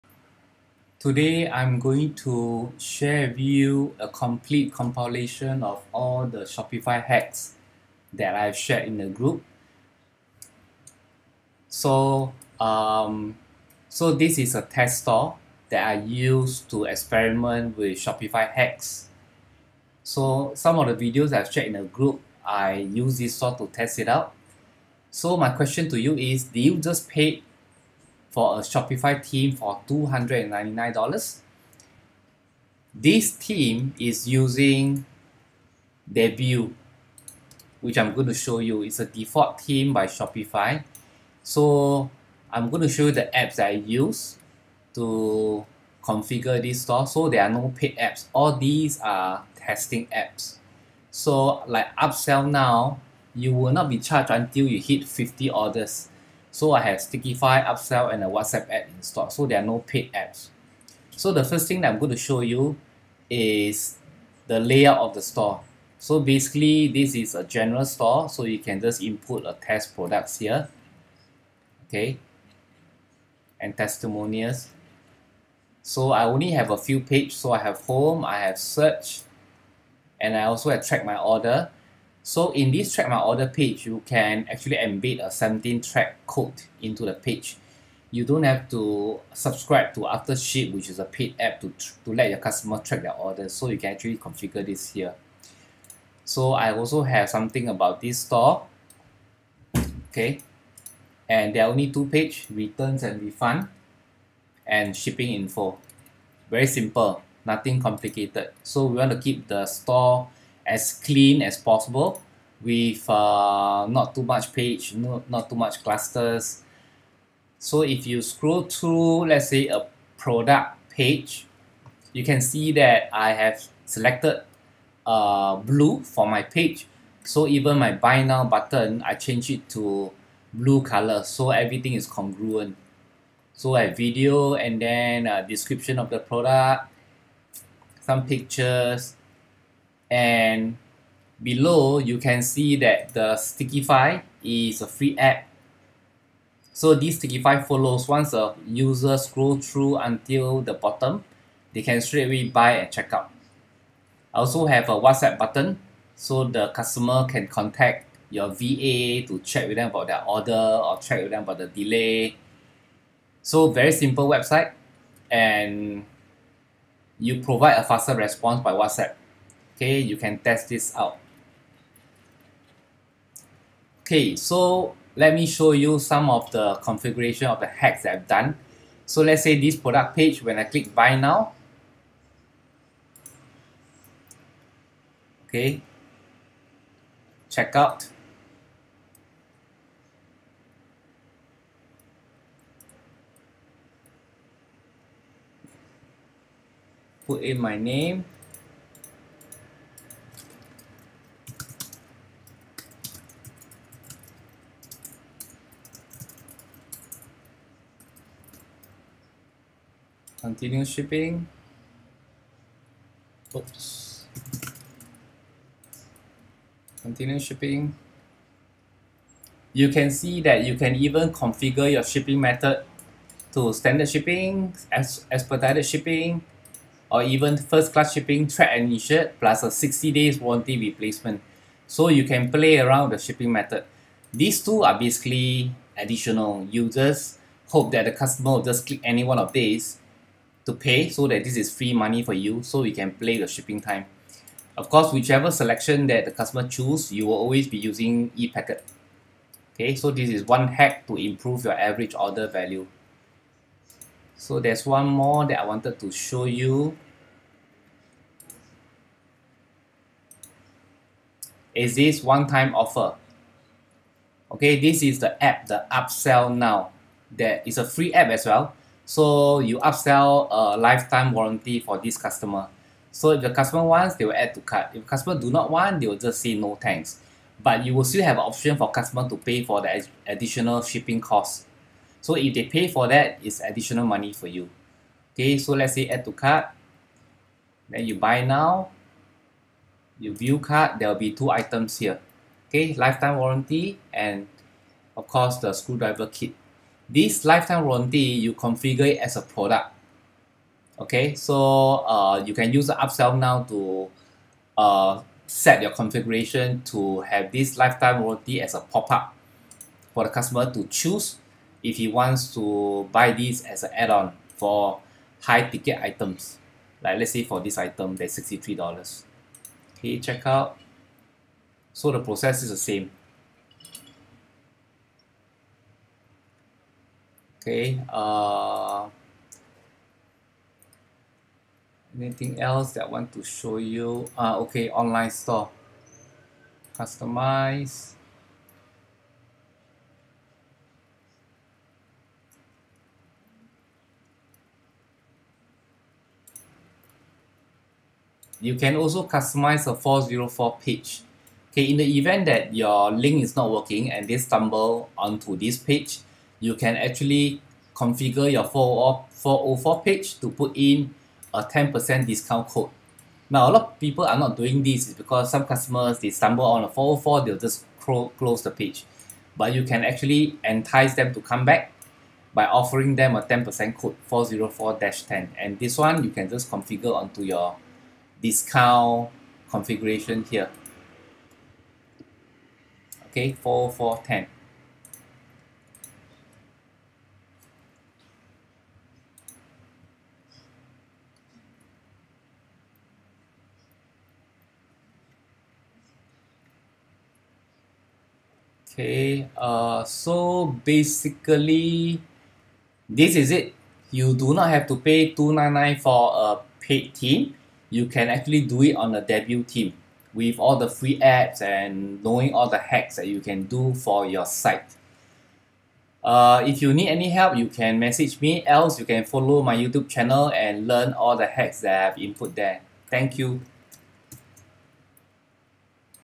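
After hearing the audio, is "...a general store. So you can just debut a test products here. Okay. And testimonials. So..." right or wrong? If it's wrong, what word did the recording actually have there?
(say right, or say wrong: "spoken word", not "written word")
wrong: "input", not "debut".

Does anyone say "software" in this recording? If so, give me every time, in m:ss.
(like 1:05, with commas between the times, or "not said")
not said.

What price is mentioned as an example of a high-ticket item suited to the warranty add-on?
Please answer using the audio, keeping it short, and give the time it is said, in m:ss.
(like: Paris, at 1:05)
$63, at 5:18.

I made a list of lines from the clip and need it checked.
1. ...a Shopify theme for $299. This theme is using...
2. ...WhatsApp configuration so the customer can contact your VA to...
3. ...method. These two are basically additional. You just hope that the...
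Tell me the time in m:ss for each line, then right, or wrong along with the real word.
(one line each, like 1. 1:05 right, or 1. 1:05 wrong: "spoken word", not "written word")
1. 0:28 right
2. 2:34 wrong: "button", not "configuration"
3. 3:53 right.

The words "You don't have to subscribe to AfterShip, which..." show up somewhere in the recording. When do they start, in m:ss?
1:28.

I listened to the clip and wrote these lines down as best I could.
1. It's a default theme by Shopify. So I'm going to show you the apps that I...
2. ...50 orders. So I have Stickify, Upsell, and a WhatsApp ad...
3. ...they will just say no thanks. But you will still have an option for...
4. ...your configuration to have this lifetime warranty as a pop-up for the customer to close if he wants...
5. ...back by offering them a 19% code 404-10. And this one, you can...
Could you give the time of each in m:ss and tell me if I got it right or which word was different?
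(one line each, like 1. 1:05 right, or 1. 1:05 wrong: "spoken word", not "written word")
1. 0:38 right
2. 0:55 right
3. 4:35 right
4. 5:05 wrong: "choose", not "close"
5. 6:11 wrong: "10", not "19".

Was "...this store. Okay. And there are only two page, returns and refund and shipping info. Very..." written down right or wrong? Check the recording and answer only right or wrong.
right.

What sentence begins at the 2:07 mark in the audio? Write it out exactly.
So even my buy now button, I change it to blue color.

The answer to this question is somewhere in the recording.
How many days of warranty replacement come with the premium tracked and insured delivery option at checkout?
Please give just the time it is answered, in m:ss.
3:49.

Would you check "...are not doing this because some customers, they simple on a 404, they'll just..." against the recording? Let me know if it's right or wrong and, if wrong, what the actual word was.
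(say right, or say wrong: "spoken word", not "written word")
wrong: "stumble", not "simple".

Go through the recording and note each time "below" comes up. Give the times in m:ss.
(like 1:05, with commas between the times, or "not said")
2:21.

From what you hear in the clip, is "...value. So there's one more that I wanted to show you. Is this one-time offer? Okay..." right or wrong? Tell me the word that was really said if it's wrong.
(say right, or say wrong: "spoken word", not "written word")
right.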